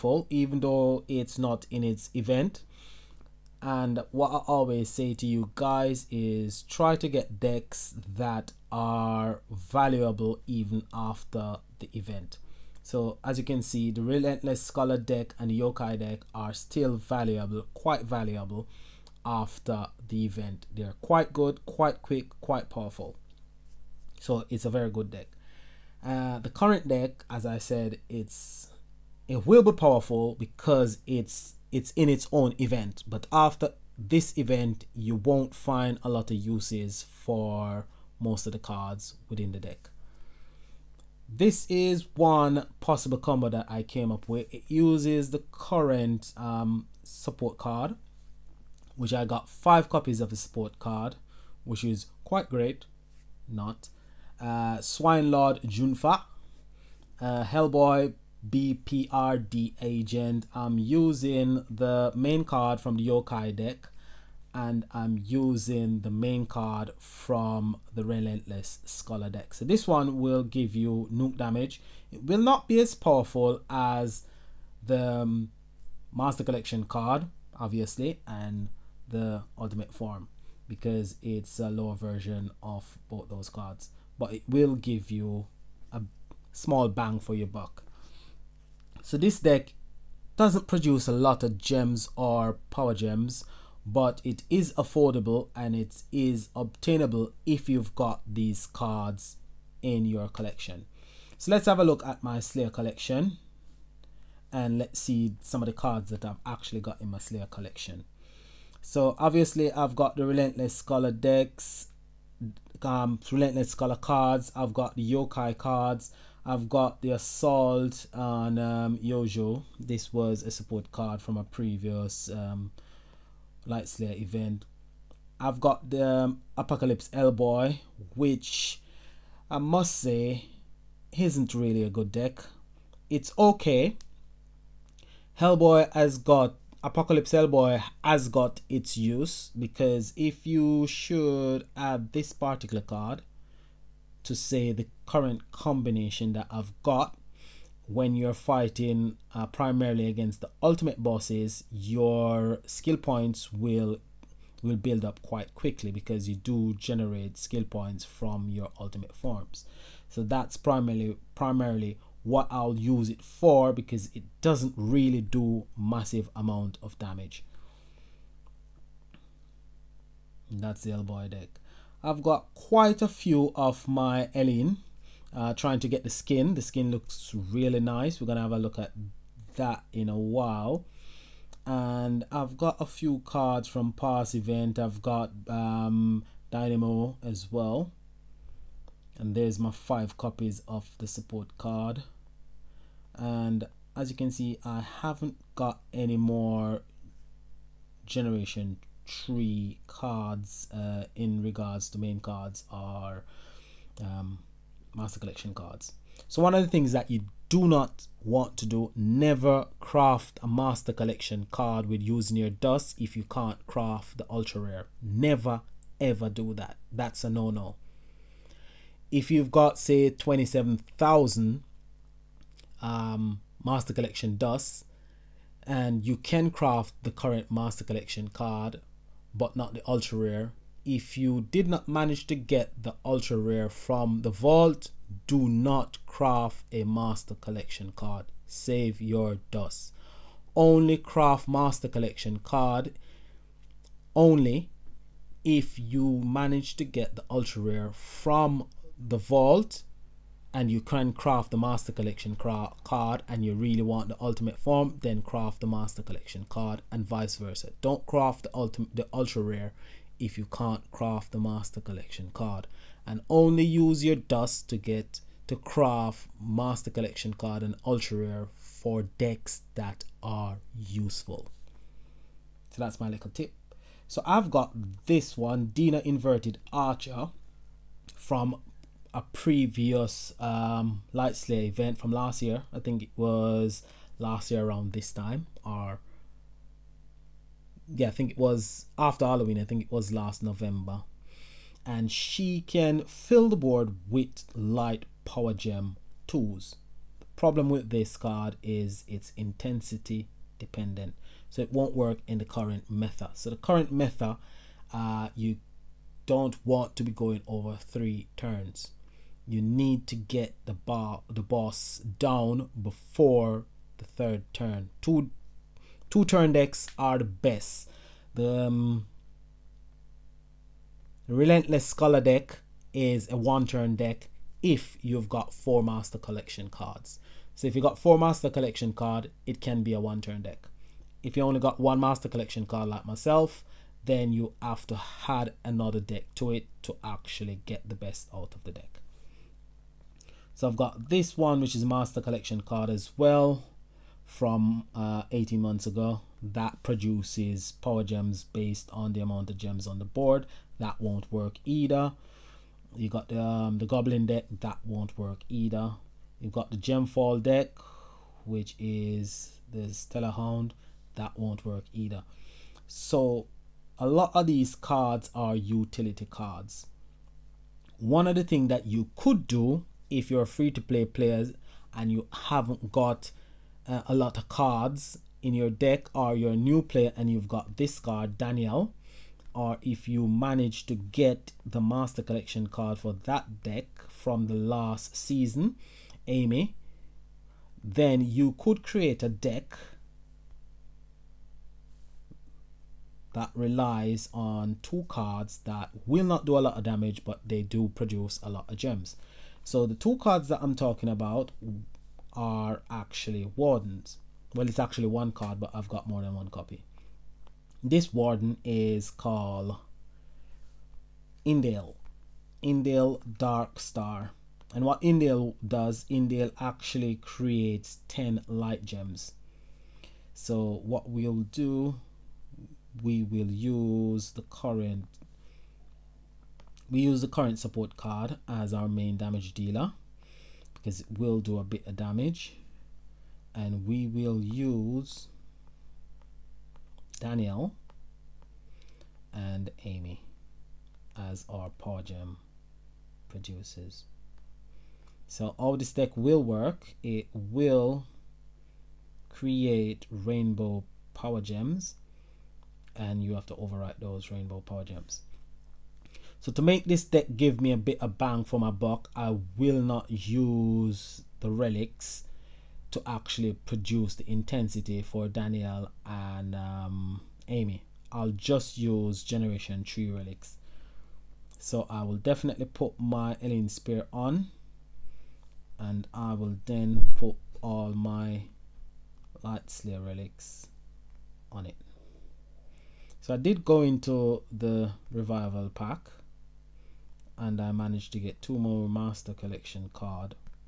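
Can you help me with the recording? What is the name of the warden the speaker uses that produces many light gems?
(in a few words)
Indale Dark Star.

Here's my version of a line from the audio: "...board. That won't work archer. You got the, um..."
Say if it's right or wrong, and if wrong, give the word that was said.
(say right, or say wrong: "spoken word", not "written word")
wrong: "either", not "archer".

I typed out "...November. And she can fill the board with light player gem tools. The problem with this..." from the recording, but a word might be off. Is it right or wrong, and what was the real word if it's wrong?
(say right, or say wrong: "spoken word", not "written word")
wrong: "power", not "player".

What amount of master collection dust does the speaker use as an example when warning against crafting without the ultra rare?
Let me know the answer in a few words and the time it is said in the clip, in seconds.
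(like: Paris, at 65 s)
27,000, at 220 s.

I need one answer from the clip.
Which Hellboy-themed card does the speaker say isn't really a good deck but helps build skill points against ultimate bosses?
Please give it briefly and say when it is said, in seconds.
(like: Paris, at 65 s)
Apocalypse Hellboy, at 136 s.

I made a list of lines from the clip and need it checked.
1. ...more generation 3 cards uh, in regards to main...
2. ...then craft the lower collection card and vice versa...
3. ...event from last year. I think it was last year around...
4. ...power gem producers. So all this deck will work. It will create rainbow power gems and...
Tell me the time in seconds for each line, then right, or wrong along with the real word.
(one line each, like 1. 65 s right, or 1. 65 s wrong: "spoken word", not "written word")
1. 196 s right
2. 255 s wrong: "master", not "lower"
3. 281 s right
4. 441 s right.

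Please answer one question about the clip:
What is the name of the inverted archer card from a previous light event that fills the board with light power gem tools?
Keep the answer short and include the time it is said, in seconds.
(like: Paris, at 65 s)
Dina, at 275 s.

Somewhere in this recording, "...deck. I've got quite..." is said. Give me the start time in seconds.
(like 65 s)
171 s.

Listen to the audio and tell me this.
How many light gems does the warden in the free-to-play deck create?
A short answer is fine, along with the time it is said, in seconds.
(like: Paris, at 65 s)
10, at 418 s.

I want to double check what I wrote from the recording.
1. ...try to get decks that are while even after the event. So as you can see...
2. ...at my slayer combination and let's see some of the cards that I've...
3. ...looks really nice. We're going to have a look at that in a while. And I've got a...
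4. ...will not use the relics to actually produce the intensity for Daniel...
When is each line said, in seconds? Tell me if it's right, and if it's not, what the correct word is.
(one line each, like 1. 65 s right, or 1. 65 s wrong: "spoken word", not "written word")
1. 6 s wrong: "valuable", not "while"
2. 102 s wrong: "collection", not "combination"
3. 176 s right
4. 459 s right.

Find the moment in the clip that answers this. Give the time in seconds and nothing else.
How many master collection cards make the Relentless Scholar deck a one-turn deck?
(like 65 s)
325 s.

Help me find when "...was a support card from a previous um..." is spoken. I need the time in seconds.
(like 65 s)
120 s.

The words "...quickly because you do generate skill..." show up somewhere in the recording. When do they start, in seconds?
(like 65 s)
155 s.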